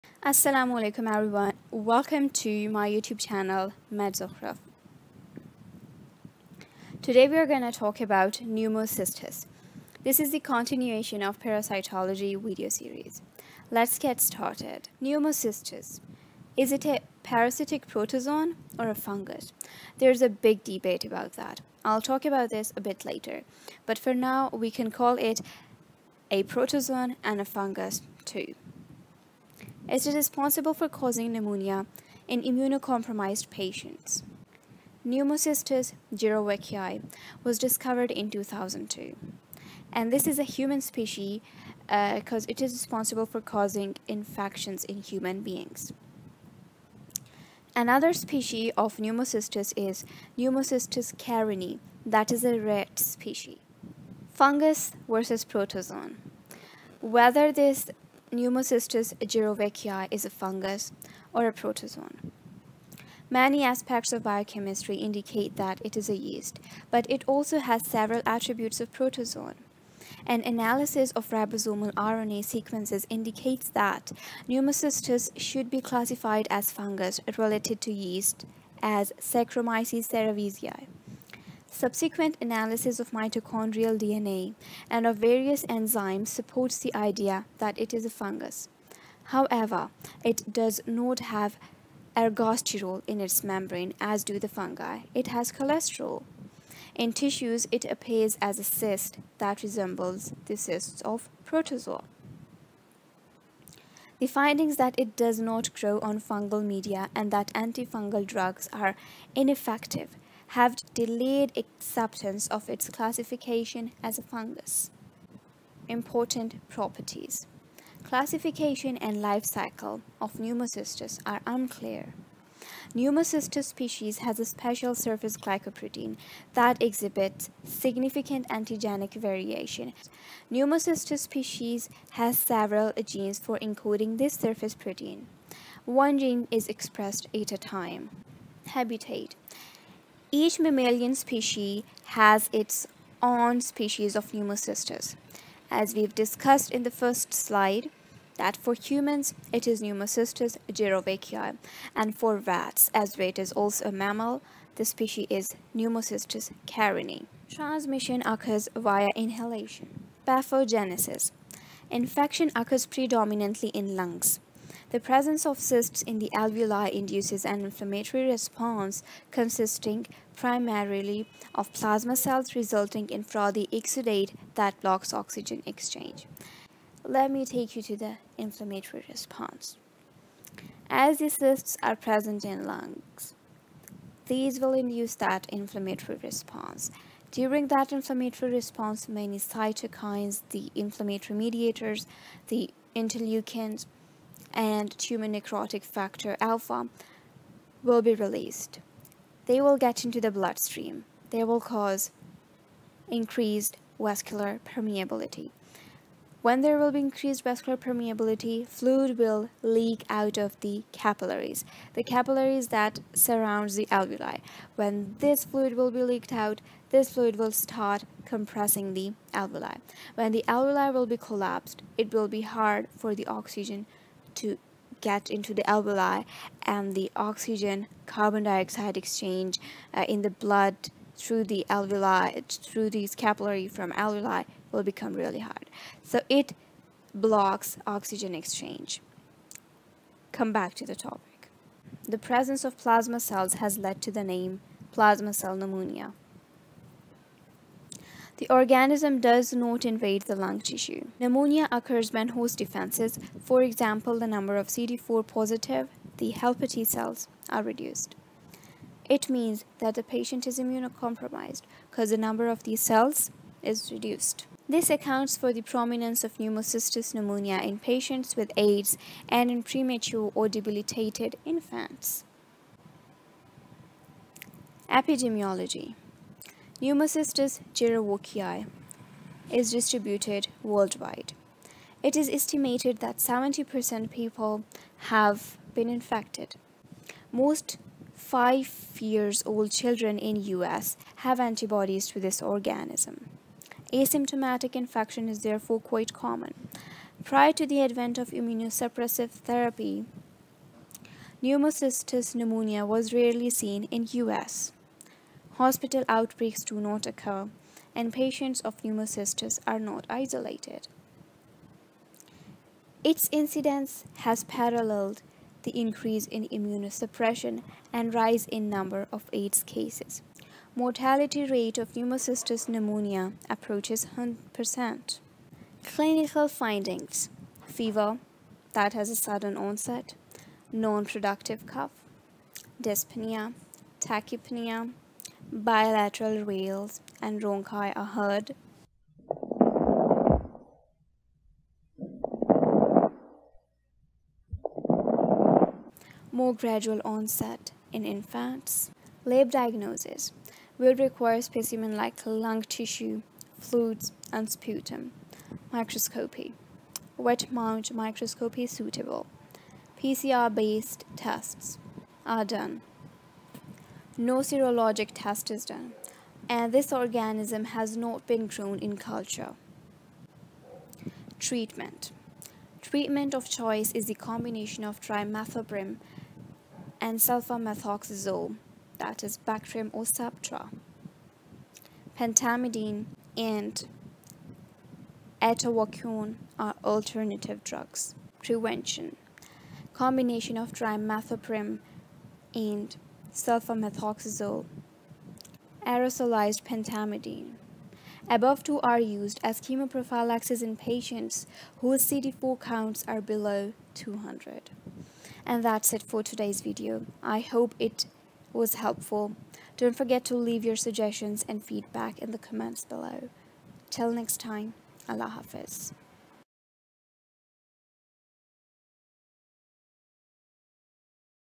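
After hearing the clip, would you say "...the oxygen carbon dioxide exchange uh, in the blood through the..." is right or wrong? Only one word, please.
right.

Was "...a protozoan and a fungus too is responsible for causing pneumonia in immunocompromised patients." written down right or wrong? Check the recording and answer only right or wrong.
right.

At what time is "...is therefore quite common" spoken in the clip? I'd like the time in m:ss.
4:55.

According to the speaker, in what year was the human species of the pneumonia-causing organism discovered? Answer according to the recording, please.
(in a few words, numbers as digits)
2002.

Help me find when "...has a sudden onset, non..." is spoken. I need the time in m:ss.
5:28.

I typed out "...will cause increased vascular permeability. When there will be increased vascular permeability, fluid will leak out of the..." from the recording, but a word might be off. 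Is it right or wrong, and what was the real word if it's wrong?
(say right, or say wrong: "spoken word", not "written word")
right.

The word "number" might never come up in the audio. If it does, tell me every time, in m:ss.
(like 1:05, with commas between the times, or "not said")
4:14, 4:22, 5:18.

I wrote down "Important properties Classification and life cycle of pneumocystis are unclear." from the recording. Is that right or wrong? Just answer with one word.
right.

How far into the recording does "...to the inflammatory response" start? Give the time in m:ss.
2:57.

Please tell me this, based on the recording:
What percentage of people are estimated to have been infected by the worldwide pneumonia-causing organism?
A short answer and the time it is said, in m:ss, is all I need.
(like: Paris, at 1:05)
70%, at 4:43.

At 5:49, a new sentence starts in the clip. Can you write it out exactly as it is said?
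Lab diagnosis will require specimen like lung tissue, fluids, and sputum.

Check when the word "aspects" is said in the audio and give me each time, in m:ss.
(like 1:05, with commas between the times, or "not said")
1:03.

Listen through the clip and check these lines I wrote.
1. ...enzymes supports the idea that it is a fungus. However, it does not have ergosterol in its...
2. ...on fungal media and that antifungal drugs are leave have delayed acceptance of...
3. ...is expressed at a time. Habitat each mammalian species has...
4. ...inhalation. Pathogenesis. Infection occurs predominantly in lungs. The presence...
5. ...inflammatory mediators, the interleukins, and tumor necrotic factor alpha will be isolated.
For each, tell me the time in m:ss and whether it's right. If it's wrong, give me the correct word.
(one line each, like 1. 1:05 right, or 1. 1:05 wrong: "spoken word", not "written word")
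1. 1:25 right
2. 1:46 wrong: "ineffective", not "leave"
3. 2:16 right
4. 2:39 right
5. 3:10 wrong: "released", not "isolated".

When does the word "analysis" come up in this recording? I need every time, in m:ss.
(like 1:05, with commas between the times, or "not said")
1:10, 1:22.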